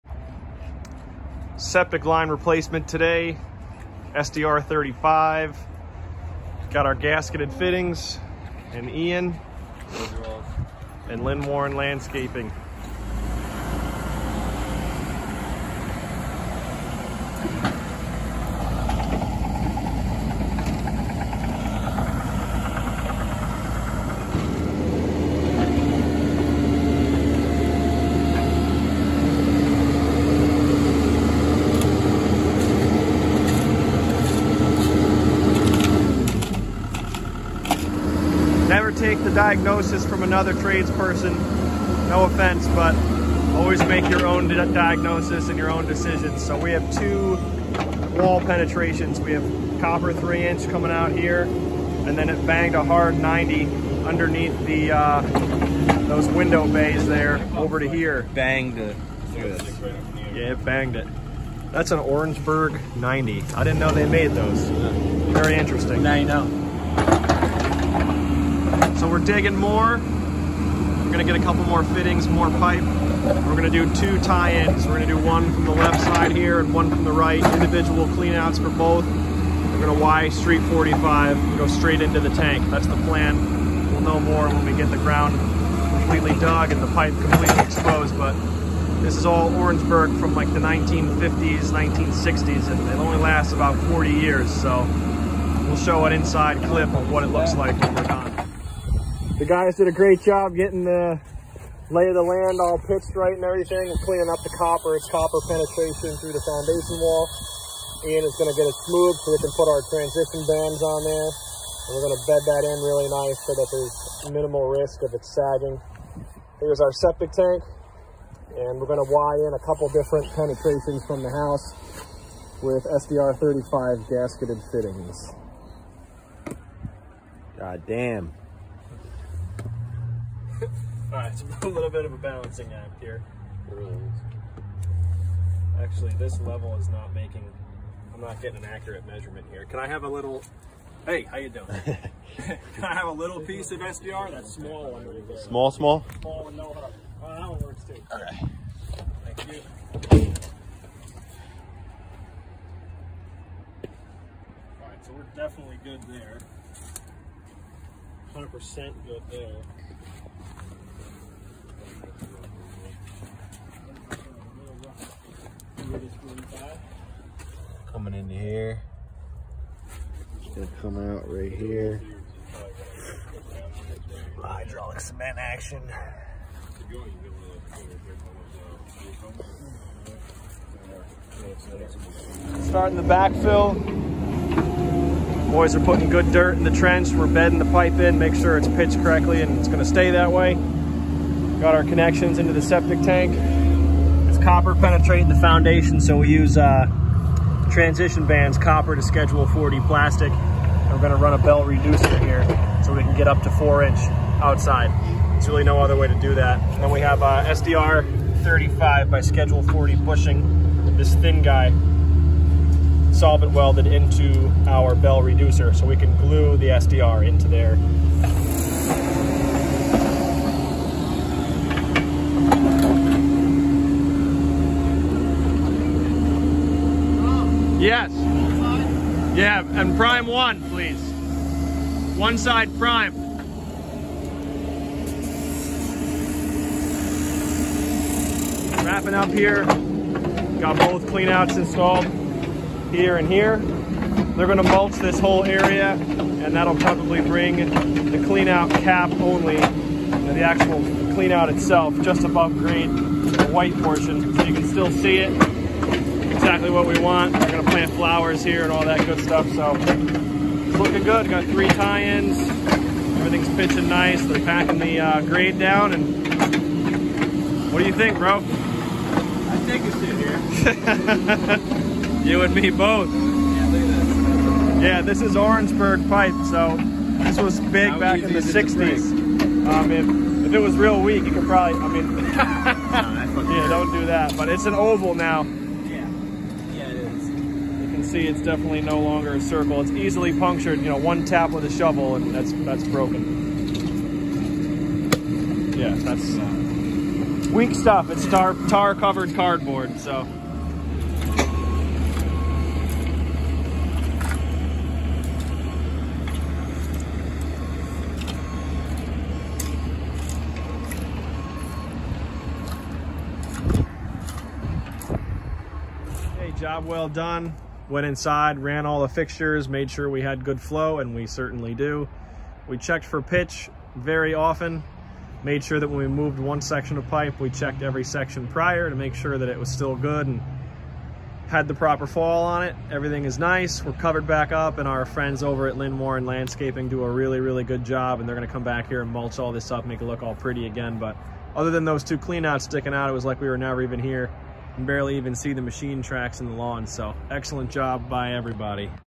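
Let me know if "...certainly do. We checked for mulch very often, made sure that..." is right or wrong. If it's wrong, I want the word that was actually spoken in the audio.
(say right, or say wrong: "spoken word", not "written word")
wrong: "pitch", not "mulch".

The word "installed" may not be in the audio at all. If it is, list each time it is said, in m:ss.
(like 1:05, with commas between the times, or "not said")
4:01.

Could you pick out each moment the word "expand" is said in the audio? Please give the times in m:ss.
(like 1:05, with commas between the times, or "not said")
not said.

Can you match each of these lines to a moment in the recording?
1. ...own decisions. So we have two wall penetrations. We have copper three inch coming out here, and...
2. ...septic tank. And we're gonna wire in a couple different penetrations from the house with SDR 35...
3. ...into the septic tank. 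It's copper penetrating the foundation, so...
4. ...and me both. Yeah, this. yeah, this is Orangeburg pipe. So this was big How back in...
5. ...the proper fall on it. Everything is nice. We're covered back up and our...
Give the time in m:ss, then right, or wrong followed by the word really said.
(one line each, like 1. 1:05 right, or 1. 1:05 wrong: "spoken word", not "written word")
1. 0:45 right
2. 1:56 right
3. 3:12 right
4. 4:32 right
5. 5:31 right.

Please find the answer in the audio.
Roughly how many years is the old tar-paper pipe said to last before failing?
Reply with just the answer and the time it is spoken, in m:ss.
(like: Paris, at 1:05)
40 years, at 1:33.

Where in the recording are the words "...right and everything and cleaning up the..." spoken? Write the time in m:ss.
1:43.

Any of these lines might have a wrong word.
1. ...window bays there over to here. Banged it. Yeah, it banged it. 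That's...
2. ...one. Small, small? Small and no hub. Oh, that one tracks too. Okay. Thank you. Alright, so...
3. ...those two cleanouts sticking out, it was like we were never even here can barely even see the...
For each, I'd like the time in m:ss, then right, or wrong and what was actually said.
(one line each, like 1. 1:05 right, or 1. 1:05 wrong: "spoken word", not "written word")
1. 0:56 right
2. 2:24 wrong: "works", not "tracks"
3. 5:41 right.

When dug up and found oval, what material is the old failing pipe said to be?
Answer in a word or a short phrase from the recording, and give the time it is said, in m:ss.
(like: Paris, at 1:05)
Tar covered cardboard, at 4:58.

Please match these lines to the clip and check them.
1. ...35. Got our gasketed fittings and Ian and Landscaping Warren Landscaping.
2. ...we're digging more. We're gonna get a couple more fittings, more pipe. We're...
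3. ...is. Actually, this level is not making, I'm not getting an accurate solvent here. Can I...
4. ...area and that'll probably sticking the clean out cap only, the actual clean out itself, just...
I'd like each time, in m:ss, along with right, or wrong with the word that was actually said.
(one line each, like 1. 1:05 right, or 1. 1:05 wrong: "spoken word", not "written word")
1. 0:04 wrong: "Lynn", not "Landscaping"
2. 1:09 right
3. 2:13 wrong: "measurement", not "solvent"
4. 4:05 wrong: "bring", not "sticking".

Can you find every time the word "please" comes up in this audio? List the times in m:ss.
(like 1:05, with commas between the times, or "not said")
3:50.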